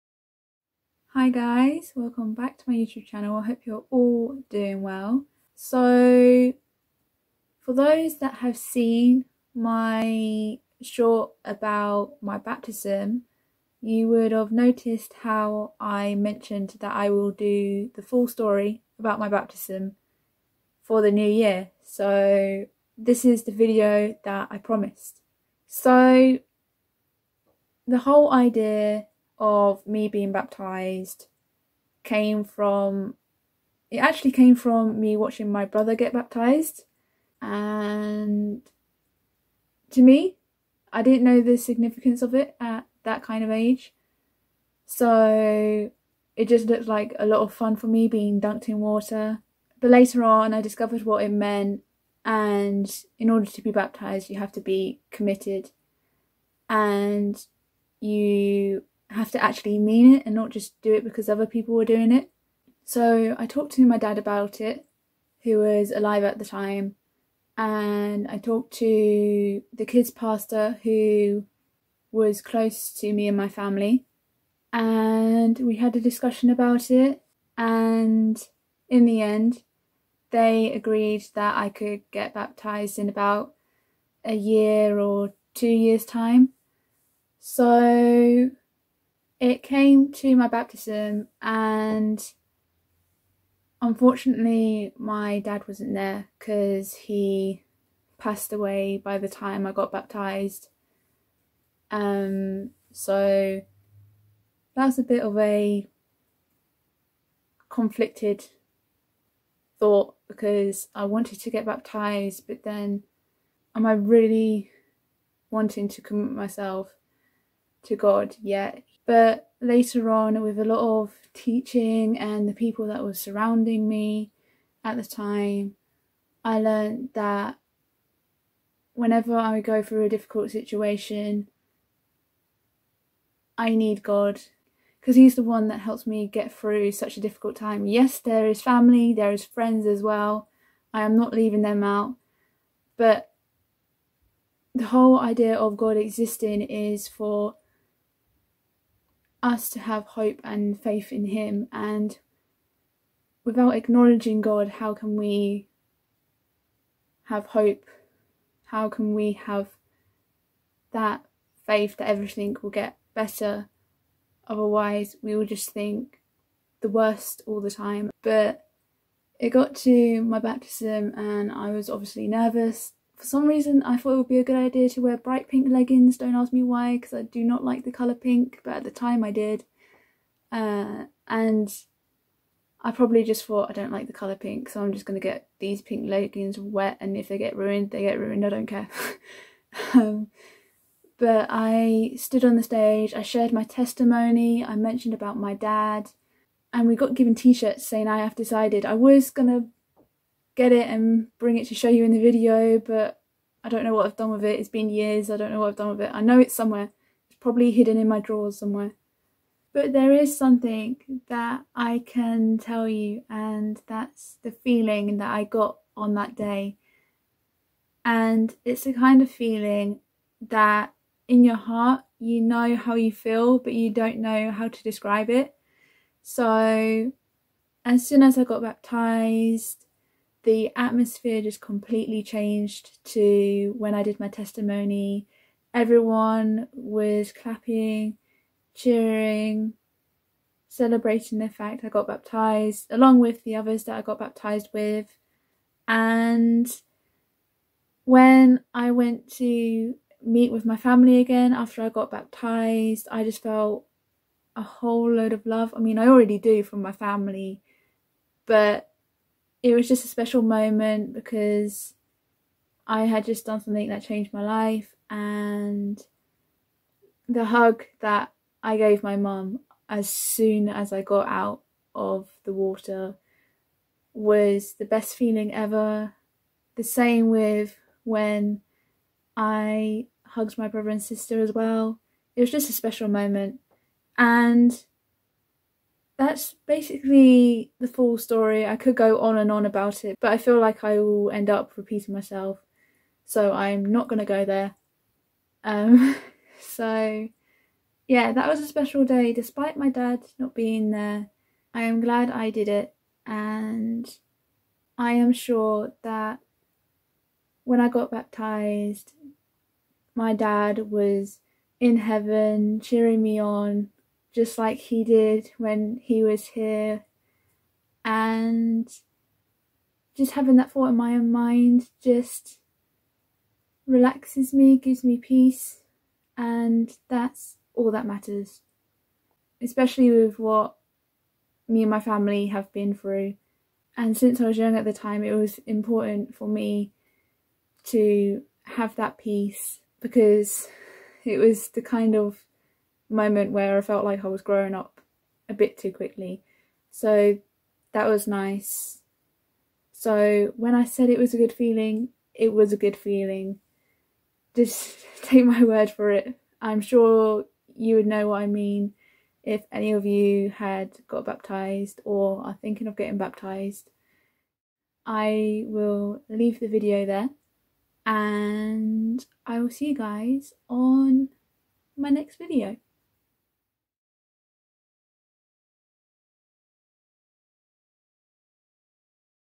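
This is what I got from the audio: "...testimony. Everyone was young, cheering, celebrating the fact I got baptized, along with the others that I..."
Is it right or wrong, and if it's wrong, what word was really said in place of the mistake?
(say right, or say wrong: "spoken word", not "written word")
wrong: "clapping", not "young".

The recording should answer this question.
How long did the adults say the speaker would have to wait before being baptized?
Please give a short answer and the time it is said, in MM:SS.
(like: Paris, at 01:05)
A year or two, at 01:23.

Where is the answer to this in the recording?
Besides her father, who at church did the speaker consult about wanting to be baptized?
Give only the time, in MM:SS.
01:09.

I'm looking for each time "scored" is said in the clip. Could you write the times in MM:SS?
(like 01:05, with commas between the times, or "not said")
not said.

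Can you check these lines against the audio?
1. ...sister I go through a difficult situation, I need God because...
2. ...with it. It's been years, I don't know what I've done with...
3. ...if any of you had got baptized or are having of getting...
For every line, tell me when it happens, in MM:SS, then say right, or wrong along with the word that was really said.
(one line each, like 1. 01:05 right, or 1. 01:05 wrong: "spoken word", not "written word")
1. 02:08 wrong: "whenever", not "sister"
2. 03:24 right
3. 05:59 wrong: "thinking", not "having".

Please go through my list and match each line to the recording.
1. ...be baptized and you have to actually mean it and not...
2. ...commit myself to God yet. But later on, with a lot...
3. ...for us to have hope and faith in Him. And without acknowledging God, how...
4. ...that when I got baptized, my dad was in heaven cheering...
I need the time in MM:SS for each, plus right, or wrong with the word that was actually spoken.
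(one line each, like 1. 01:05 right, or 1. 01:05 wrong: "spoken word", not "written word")
1. 00:54 wrong: "committed", not "baptized"
2. 01:55 right
3. 02:27 right
4. 05:06 right.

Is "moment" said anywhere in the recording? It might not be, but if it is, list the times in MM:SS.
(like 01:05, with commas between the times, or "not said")
04:20, 04:43, 05:43.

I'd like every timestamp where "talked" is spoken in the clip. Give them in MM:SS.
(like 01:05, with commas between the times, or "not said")
01:03, 01:08.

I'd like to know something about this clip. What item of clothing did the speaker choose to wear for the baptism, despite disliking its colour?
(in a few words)
Bright pink leggings.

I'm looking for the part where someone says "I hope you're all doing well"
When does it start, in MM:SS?
00:03.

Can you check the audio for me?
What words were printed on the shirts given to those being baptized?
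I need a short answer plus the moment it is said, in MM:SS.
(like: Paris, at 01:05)
I have decided, at 03:18.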